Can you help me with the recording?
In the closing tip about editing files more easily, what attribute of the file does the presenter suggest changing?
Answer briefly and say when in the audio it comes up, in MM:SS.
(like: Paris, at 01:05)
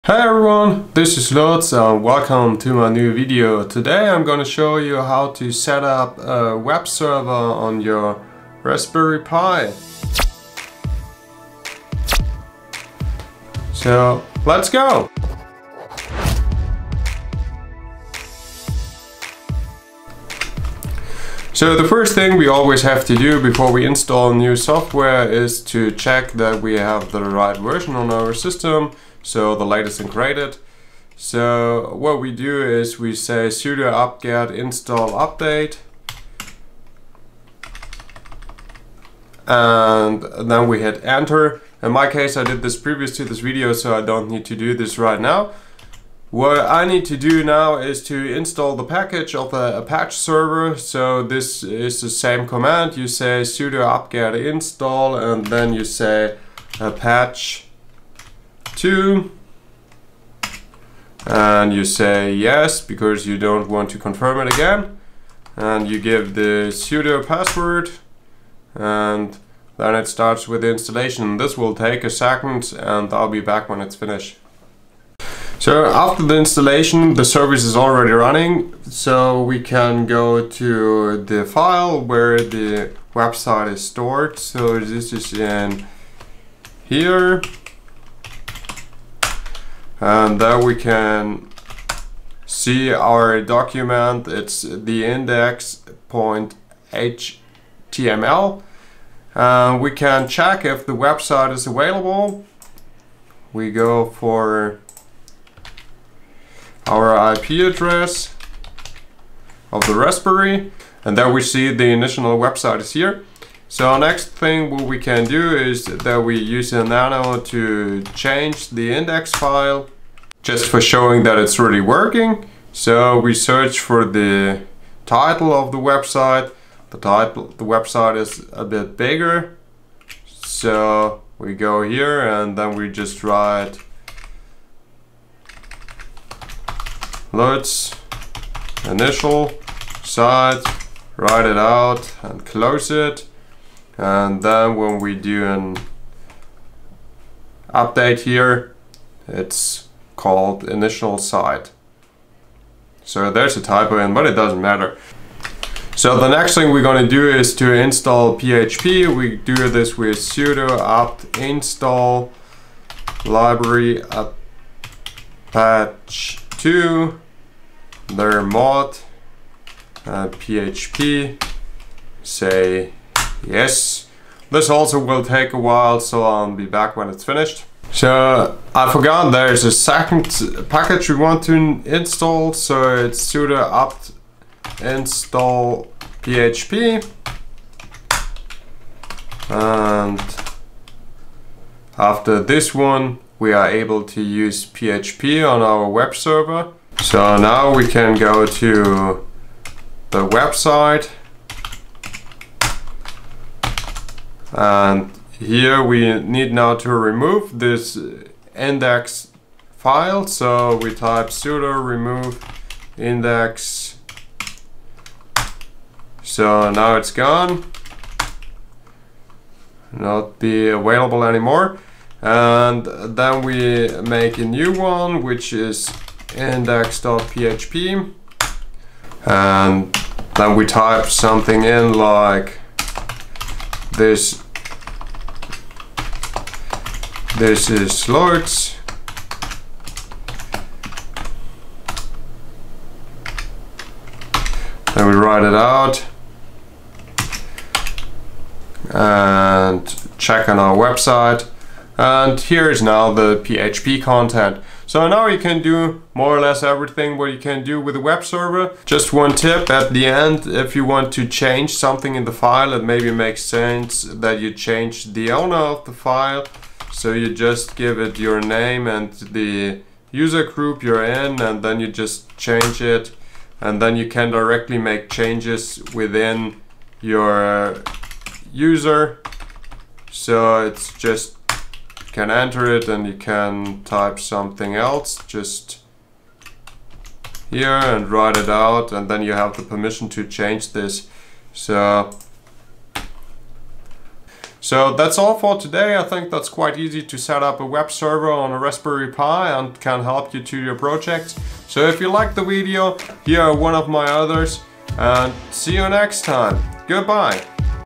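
the owner, at 04:25.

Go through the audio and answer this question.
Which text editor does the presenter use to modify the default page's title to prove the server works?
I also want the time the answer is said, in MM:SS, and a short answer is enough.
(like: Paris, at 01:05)
nano, at 01:56.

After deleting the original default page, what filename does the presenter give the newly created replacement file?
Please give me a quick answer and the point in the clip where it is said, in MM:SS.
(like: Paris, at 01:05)
index.php, at 03:46.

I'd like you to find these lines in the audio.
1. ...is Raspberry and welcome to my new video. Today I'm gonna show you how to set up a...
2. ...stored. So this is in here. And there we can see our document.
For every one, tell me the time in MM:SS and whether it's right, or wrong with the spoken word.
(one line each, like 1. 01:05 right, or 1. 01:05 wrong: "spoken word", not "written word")
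1. 00:01 wrong: "Lutz", not "Raspberry"
2. 01:23 right.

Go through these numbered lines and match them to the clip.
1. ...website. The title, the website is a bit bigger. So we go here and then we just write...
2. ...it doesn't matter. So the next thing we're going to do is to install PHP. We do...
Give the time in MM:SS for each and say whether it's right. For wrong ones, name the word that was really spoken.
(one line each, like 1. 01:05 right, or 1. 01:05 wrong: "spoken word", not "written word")
1. 02:05 right
2. 02:34 right.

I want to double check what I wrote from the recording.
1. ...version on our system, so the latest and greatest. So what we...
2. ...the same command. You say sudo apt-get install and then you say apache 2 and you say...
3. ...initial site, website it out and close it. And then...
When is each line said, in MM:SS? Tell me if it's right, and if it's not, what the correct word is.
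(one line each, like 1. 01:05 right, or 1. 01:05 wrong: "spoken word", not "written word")
1. 00:27 right
2. 00:51 right
3. 02:18 wrong: "write", not "website".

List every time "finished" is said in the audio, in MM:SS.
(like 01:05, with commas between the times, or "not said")
01:13, 02:57.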